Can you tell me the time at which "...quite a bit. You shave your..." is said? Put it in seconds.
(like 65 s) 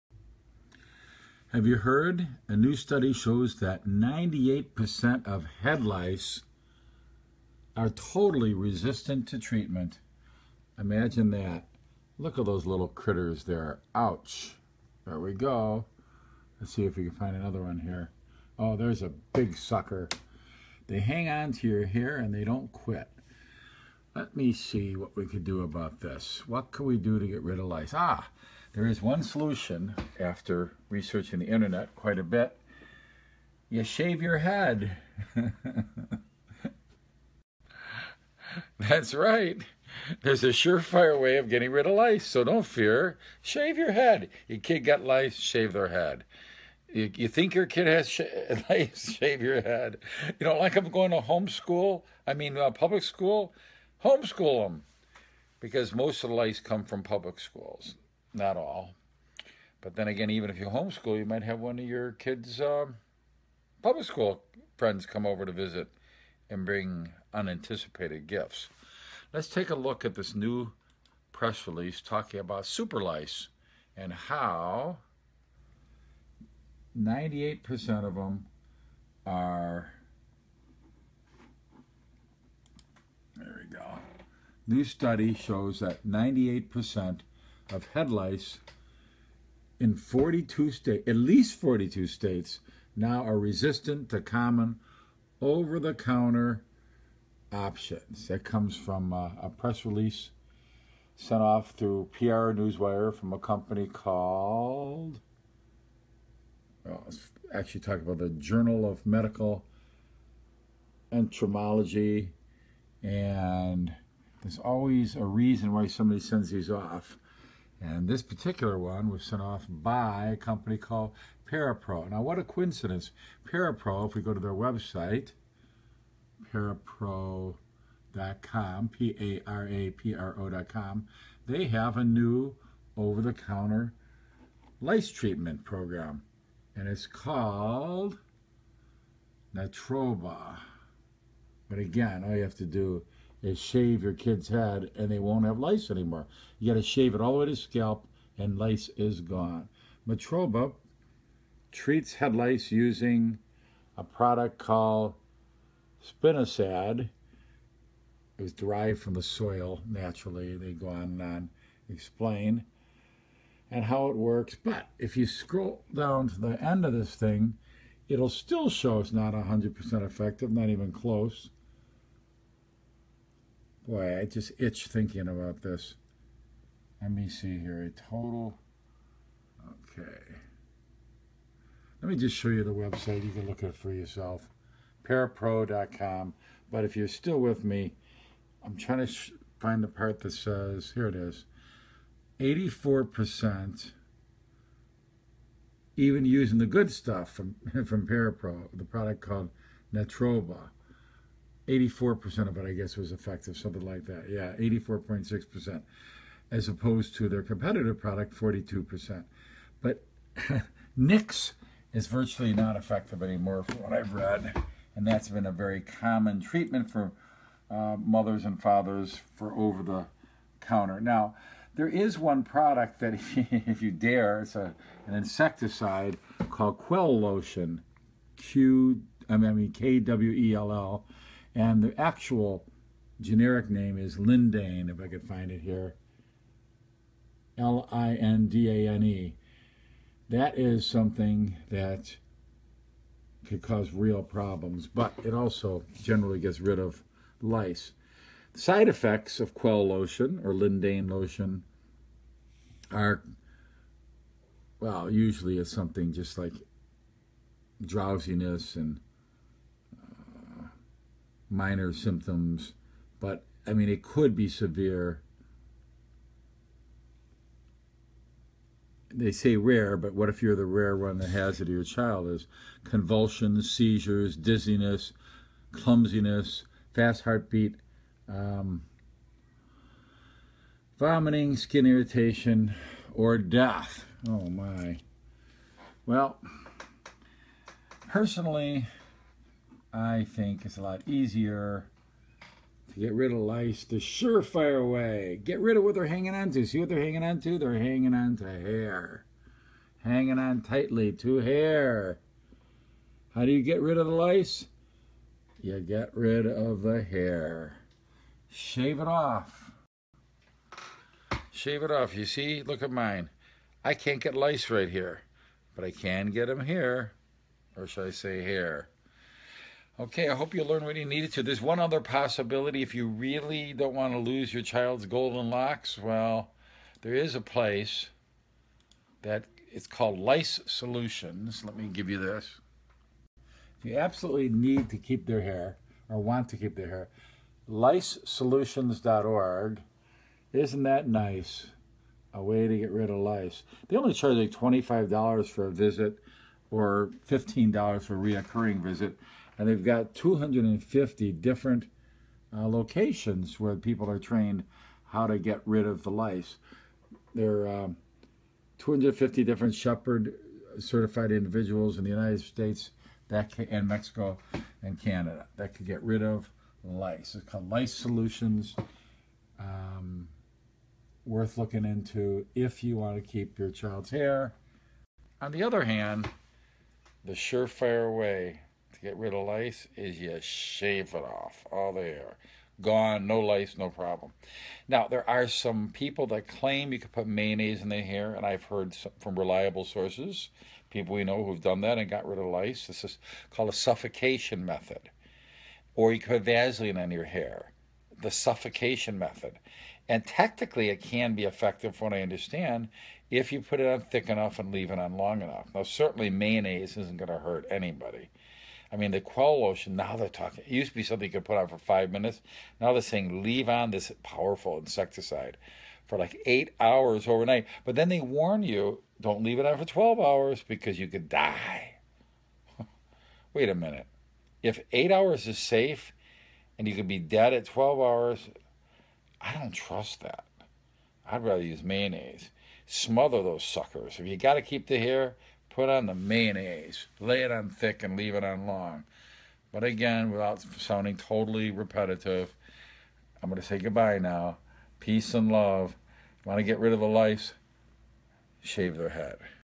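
31 s.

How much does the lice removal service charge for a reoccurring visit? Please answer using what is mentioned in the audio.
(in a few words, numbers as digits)
$15.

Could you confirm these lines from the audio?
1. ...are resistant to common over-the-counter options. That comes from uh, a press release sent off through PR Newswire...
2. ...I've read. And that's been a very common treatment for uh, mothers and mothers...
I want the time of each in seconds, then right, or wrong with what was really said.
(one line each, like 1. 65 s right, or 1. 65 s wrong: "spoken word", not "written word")
1. 93 s right
2. 213 s wrong: "fathers", not "mothers".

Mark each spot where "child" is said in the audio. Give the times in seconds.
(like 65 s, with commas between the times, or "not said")
271 s, 324 s, 373 s.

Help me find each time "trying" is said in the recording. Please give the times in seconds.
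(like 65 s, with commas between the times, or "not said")
188 s.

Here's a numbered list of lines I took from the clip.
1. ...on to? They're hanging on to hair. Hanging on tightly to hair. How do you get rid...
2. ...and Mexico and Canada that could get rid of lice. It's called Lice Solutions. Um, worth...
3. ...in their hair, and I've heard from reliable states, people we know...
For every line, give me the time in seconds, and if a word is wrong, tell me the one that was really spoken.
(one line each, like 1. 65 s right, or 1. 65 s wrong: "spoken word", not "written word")
1. 297 s right
2. 363 s right
3. 387 s wrong: "sources", not "states".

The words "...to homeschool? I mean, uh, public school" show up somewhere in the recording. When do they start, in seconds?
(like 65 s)
51 s.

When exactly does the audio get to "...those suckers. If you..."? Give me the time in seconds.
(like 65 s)
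433 s.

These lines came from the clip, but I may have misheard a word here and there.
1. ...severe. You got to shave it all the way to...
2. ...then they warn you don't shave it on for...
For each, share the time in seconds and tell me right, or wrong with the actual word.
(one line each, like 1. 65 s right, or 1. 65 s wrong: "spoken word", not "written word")
1. 145 s wrong: "anymore", not "severe"
2. 417 s wrong: "leave", not "shave".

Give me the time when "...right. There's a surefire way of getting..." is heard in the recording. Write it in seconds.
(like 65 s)
39 s.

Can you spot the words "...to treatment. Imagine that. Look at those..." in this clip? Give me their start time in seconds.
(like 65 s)
9 s.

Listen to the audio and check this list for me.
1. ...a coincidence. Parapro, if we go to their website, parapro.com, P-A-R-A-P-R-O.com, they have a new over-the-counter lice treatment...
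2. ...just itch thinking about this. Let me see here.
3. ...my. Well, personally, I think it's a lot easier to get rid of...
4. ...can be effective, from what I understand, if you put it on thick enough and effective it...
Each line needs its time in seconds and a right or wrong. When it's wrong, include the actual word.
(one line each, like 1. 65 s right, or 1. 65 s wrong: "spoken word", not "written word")
1. 122 s right
2. 174 s right
3. 284 s right
4. 401 s wrong: "leave", not "effective".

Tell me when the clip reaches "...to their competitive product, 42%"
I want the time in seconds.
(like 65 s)
207 s.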